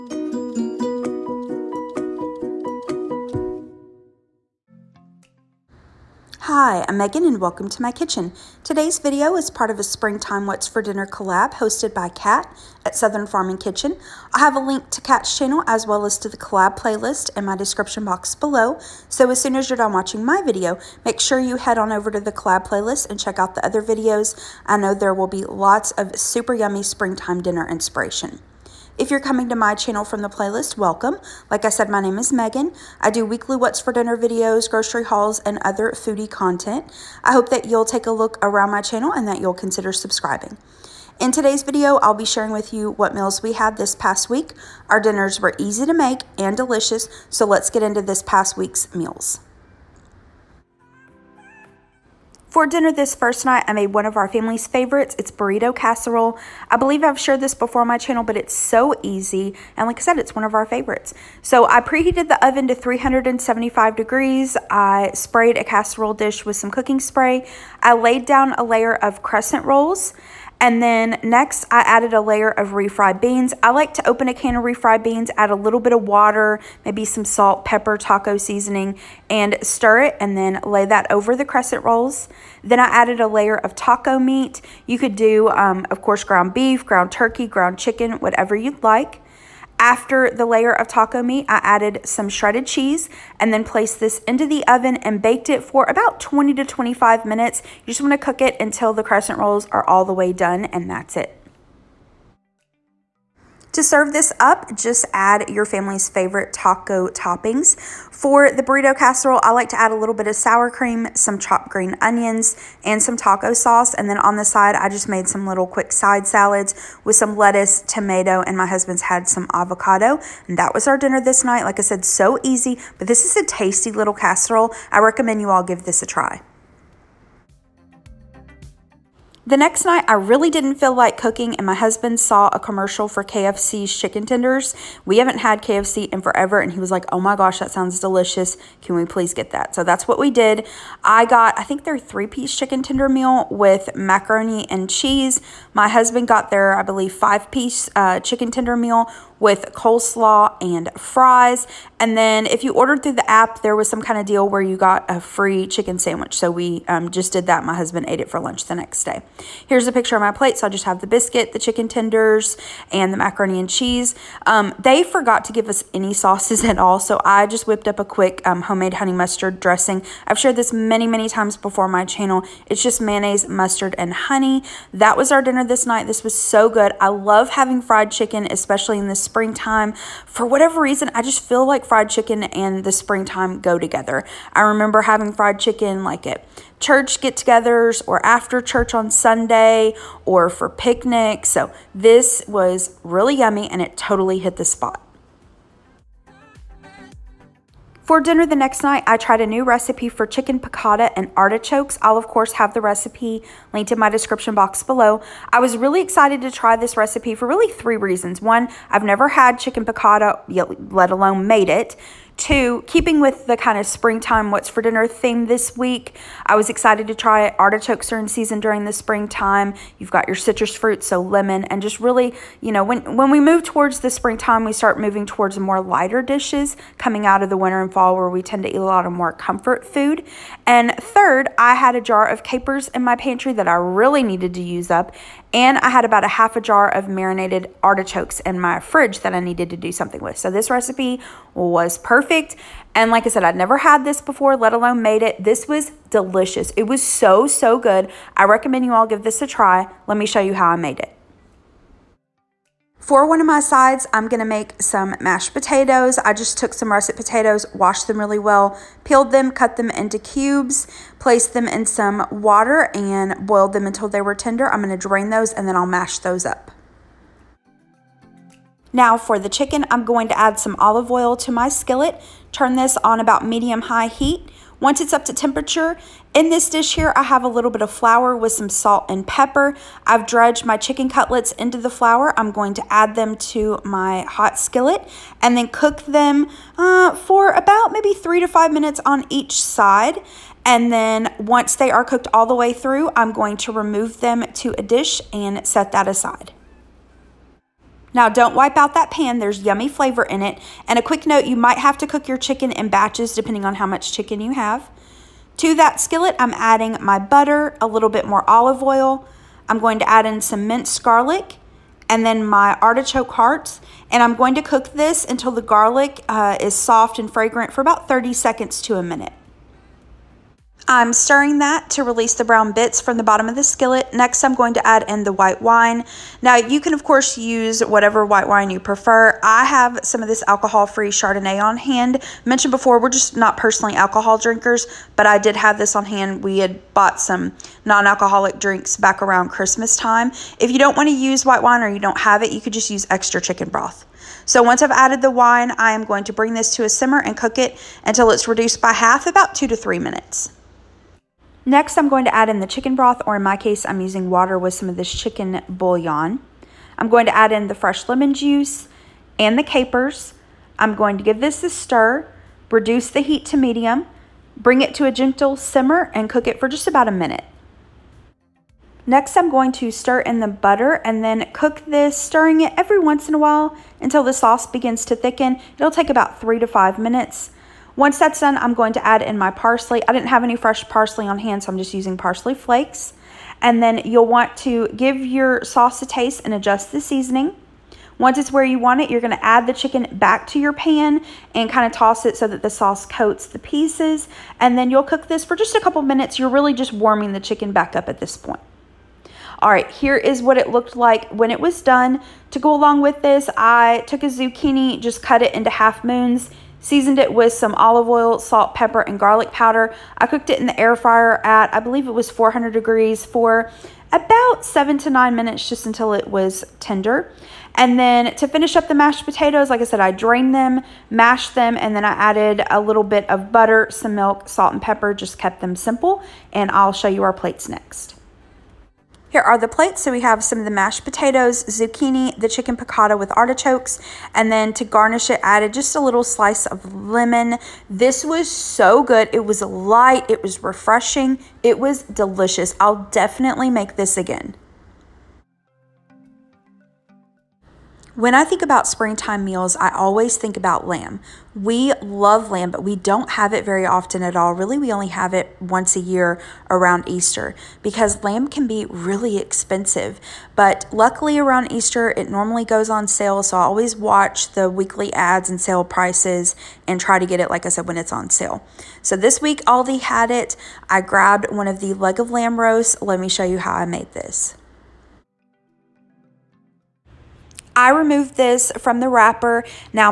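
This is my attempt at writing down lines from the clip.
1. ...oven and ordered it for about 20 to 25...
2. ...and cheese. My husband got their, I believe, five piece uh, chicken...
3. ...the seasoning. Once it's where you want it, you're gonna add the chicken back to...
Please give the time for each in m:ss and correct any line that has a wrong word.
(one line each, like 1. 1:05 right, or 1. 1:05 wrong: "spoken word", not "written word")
1. 1:34 wrong: "baked", not "ordered"
2. 2:24 right
3. 6:26 right.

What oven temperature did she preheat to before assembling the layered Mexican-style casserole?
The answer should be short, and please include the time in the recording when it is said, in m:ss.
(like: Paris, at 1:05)
375 degrees, at 1:02.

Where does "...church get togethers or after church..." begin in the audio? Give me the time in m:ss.
3:06.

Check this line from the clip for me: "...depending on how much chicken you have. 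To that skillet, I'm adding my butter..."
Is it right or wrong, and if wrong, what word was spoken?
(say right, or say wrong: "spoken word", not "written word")
right.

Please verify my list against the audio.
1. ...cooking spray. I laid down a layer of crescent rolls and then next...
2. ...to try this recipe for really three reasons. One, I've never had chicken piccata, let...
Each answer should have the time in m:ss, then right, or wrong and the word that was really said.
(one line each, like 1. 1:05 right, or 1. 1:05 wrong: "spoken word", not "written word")
1. 1:06 right
2. 3:26 right.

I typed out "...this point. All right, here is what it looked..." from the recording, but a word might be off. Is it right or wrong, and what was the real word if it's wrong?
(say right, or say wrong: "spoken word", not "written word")
right.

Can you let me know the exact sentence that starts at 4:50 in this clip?
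And then once they are cooked all the way through, I'm going to remove them to a dish and set that aside.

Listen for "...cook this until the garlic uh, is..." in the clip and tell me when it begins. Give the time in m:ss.
5:14.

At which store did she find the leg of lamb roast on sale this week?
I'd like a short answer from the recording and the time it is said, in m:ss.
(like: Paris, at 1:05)
Aldi, at 7:49.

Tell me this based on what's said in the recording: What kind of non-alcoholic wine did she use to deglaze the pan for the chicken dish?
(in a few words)
Chardonnay.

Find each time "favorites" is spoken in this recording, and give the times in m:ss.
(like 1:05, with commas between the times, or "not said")
0:54, 1:00, 1:46.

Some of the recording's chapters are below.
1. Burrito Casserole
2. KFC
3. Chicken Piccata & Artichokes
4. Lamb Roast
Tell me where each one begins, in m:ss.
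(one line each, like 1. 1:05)
1. 0:56
2. 2:13
3. 3:23
4. 7:33.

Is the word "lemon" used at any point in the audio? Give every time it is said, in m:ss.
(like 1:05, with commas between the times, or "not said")
3:41, 5:58, 7:16.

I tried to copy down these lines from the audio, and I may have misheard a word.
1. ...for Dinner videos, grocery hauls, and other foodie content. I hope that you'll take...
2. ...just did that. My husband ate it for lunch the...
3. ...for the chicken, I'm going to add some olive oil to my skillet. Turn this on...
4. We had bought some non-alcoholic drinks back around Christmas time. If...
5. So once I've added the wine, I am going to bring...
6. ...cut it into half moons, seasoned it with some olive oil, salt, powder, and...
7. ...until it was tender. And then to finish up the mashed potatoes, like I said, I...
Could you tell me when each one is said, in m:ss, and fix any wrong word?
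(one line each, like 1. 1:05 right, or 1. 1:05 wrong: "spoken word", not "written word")
1. 0:33 right
2. 2:37 right
3. 4:29 right
4. 5:36 right
5. 5:44 right
6. 6:45 wrong: "pepper", not "powder"
7. 6:55 right.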